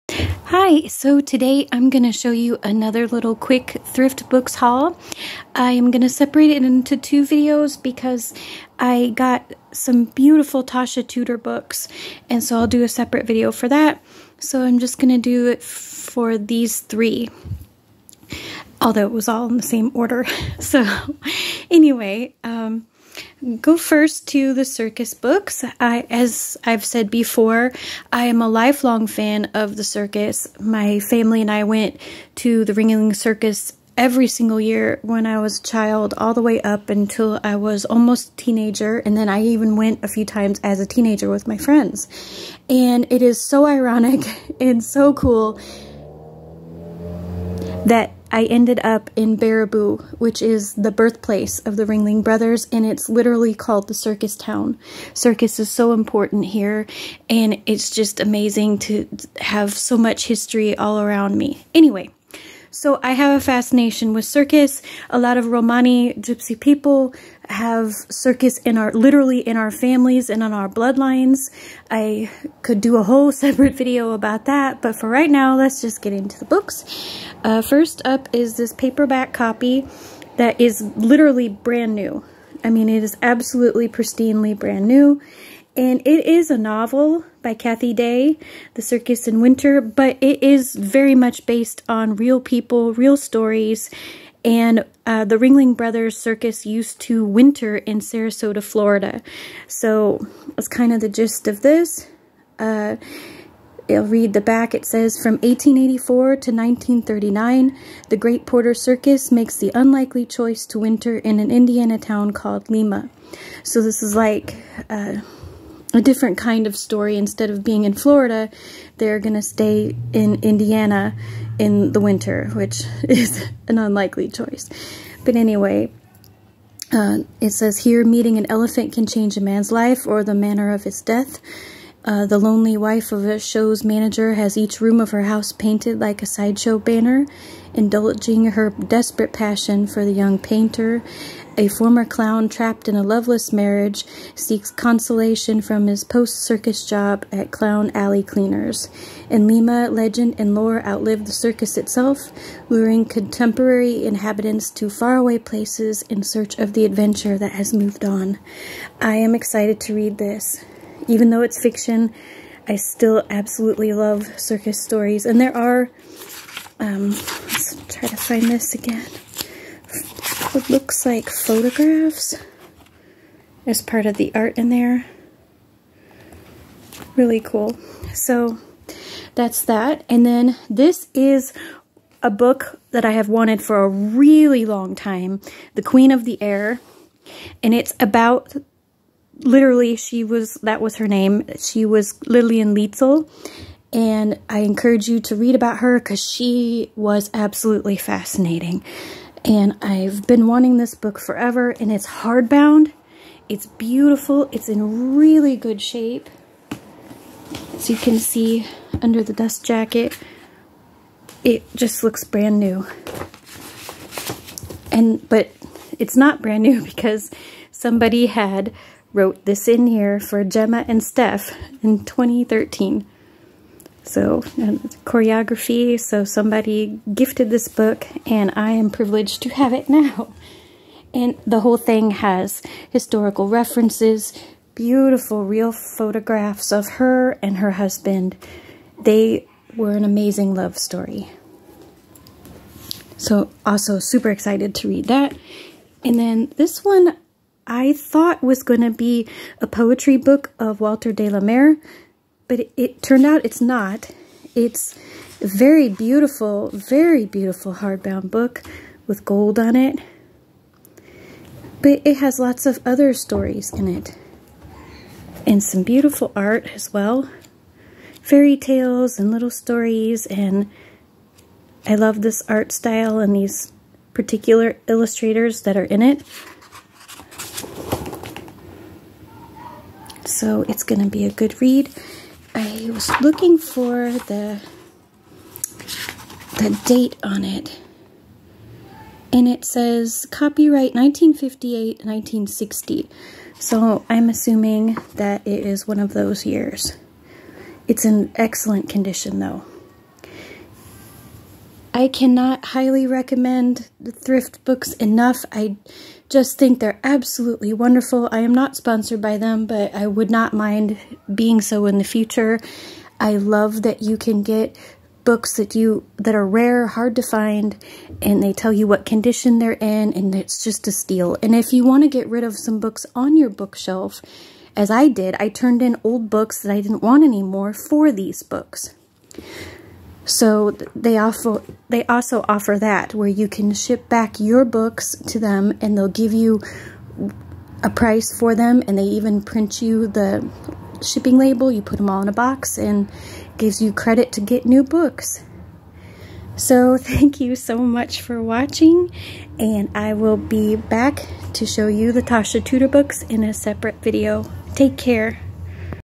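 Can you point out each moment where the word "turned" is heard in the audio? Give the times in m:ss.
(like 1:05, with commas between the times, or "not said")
4:13, 5:25.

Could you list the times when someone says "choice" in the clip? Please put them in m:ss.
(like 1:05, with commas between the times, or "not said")
1:50, 2:04.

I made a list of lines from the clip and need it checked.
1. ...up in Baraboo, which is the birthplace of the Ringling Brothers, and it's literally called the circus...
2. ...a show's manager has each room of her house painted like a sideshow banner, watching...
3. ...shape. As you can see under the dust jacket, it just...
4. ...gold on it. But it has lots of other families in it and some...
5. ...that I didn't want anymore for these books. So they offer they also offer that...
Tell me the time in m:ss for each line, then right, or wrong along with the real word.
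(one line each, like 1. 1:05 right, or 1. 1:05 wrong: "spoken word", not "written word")
1. 0:48 right
2. 2:13 wrong: "indulging", not "watching"
3. 3:25 right
4. 4:19 wrong: "stories", not "families"
5. 5:26 right.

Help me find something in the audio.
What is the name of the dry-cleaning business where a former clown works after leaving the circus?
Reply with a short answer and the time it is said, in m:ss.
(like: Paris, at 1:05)
Clown Alley Cleaners, at 2:27.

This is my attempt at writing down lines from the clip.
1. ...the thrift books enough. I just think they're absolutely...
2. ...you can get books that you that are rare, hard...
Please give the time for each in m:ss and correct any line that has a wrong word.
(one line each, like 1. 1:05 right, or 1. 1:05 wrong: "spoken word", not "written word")
1. 5:03 right
2. 5:14 right.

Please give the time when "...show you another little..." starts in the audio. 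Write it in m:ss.
0:02.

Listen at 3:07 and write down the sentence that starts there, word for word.
And it's about literally she was, that was her name.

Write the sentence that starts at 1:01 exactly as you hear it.
Anyway, so I have a fascination with circus.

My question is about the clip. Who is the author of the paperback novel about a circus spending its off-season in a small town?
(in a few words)
Cathy Day.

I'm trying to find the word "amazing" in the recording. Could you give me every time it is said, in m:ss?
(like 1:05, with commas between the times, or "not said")
0:58, 4:00.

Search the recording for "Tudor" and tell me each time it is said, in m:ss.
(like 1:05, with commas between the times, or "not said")
0:11, 5:52.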